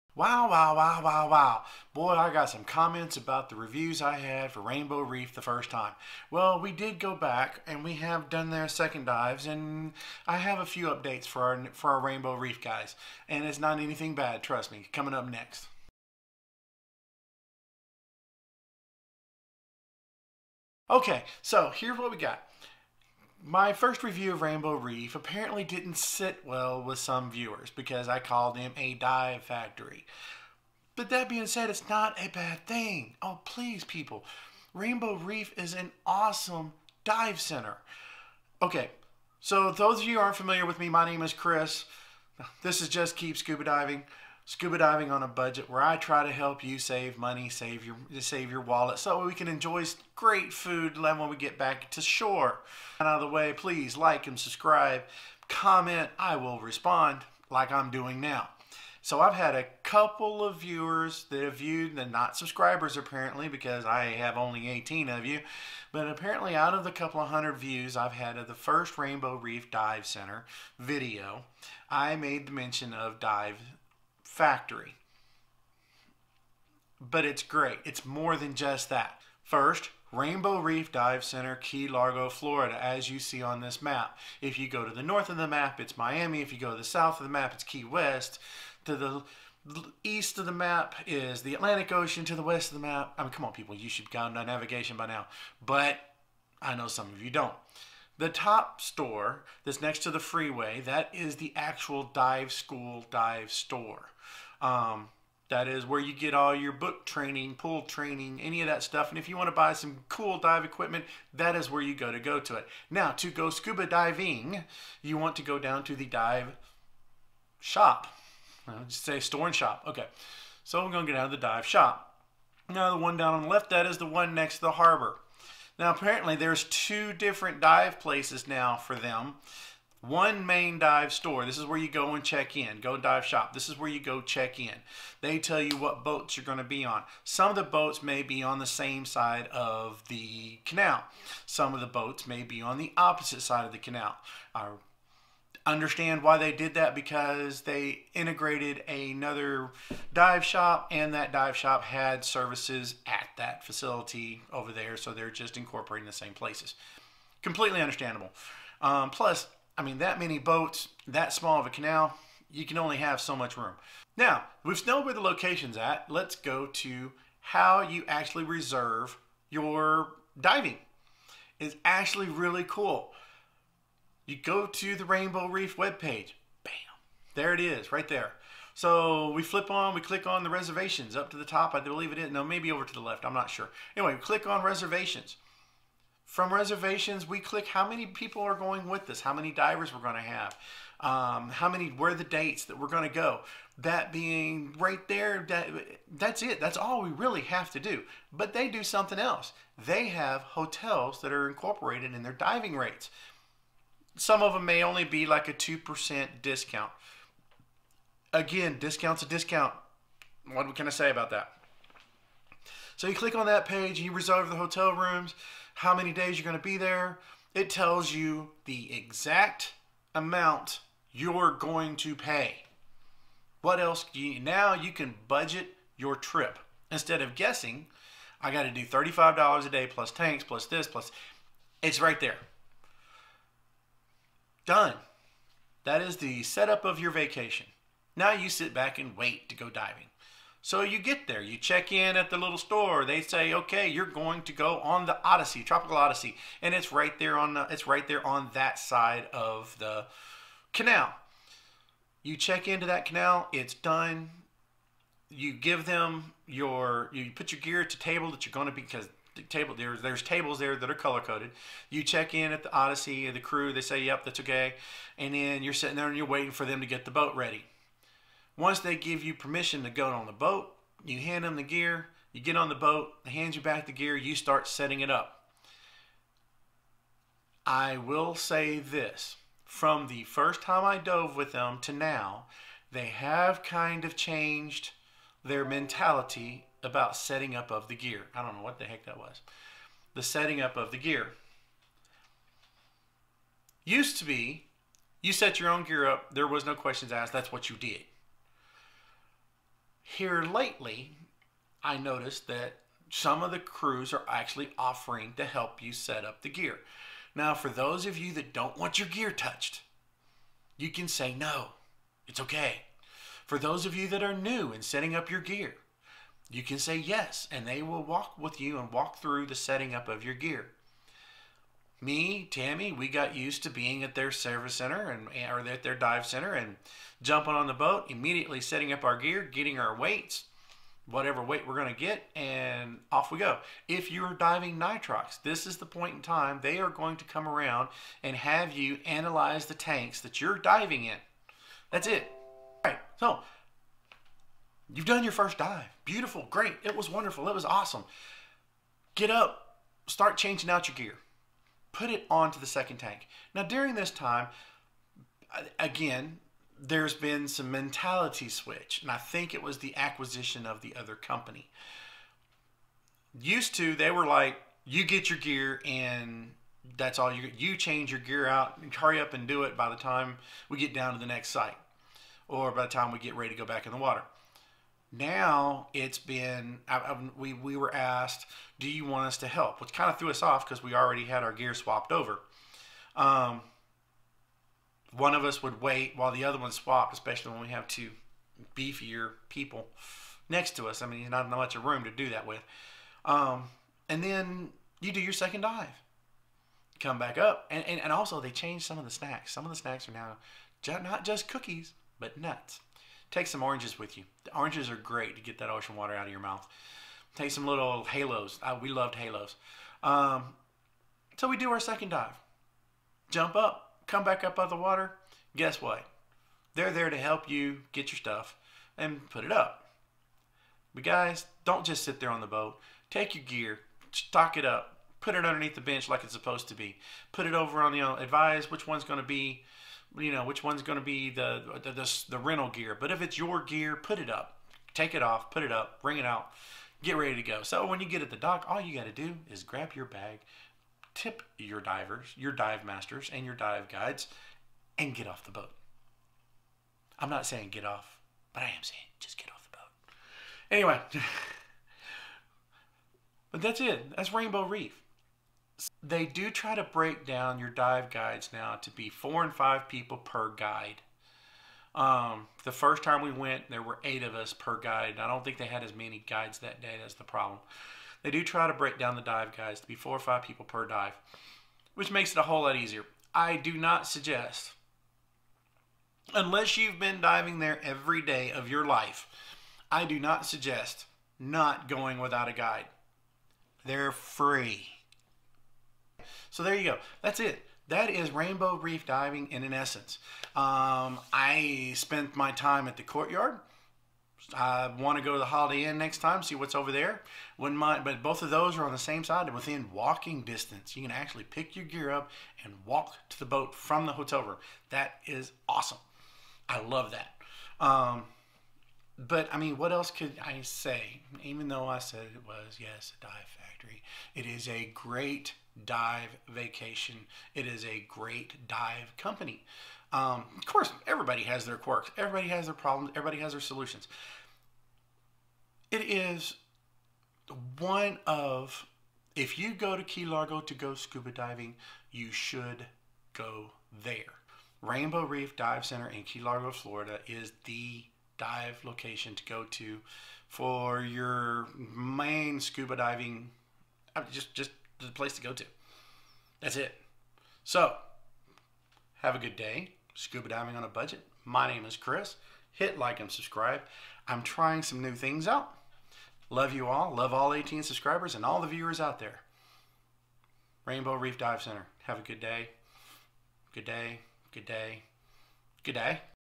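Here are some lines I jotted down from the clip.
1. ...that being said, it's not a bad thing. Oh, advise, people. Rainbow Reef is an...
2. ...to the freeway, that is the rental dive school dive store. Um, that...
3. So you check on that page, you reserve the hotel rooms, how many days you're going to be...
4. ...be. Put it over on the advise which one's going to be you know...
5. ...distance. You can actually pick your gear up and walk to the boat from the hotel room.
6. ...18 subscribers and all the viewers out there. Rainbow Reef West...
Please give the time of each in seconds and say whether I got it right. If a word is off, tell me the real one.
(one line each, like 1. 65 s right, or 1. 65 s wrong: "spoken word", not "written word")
1. 31 s wrong: "please", not "advise"
2. 99 s wrong: "actual", not "rental"
3. 212 s wrong: "click", not "check"
4. 426 s right
5. 500 s right
6. 557 s wrong: "Dive", not "West".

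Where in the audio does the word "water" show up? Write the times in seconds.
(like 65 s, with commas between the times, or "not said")
373 s, 405 s, 414 s.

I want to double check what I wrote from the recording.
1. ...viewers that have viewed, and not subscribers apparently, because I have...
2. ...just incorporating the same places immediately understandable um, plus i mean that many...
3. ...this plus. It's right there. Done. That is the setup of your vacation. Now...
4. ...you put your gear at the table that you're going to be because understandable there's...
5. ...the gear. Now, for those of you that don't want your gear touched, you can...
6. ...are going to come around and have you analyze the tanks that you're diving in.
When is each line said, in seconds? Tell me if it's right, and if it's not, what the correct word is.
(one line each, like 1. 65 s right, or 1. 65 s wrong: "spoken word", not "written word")
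1. 60 s right
2. 155 s wrong: "completely", not "immediately"
3. 230 s right
4. 257 s wrong: "table", not "understandable"
5. 306 s right
6. 336 s right.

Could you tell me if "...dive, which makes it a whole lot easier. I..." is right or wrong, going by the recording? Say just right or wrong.
right.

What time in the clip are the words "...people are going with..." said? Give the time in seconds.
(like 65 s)
188 s.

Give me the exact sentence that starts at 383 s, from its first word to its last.
Um, one of us would wait while the other one swapped, especially when we have two beefier people next to us.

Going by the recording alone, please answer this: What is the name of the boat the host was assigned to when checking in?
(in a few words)
Tropical Odyssey.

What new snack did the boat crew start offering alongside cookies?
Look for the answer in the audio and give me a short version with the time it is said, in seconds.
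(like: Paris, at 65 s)
nuts, at 402 s.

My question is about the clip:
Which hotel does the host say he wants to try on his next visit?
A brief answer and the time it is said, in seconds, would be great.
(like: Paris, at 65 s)
Holiday Inn, at 495 s.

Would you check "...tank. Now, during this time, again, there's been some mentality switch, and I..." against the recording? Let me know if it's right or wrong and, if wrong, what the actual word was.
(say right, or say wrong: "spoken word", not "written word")
right.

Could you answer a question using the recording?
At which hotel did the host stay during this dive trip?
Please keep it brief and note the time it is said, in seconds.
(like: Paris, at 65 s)
the Courtyard, at 492 s.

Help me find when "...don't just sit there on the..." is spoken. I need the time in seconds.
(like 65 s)
421 s.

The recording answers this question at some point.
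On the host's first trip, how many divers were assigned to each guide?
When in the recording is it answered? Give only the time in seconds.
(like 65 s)
464 s.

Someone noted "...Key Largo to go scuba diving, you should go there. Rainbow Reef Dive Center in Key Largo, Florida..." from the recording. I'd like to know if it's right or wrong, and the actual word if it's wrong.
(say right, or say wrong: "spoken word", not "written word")
right.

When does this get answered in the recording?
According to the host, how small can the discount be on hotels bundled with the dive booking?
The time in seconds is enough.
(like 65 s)
205 s.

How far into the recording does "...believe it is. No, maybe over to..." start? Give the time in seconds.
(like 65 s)
181 s.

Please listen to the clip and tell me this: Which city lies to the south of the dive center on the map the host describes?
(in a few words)
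Key West.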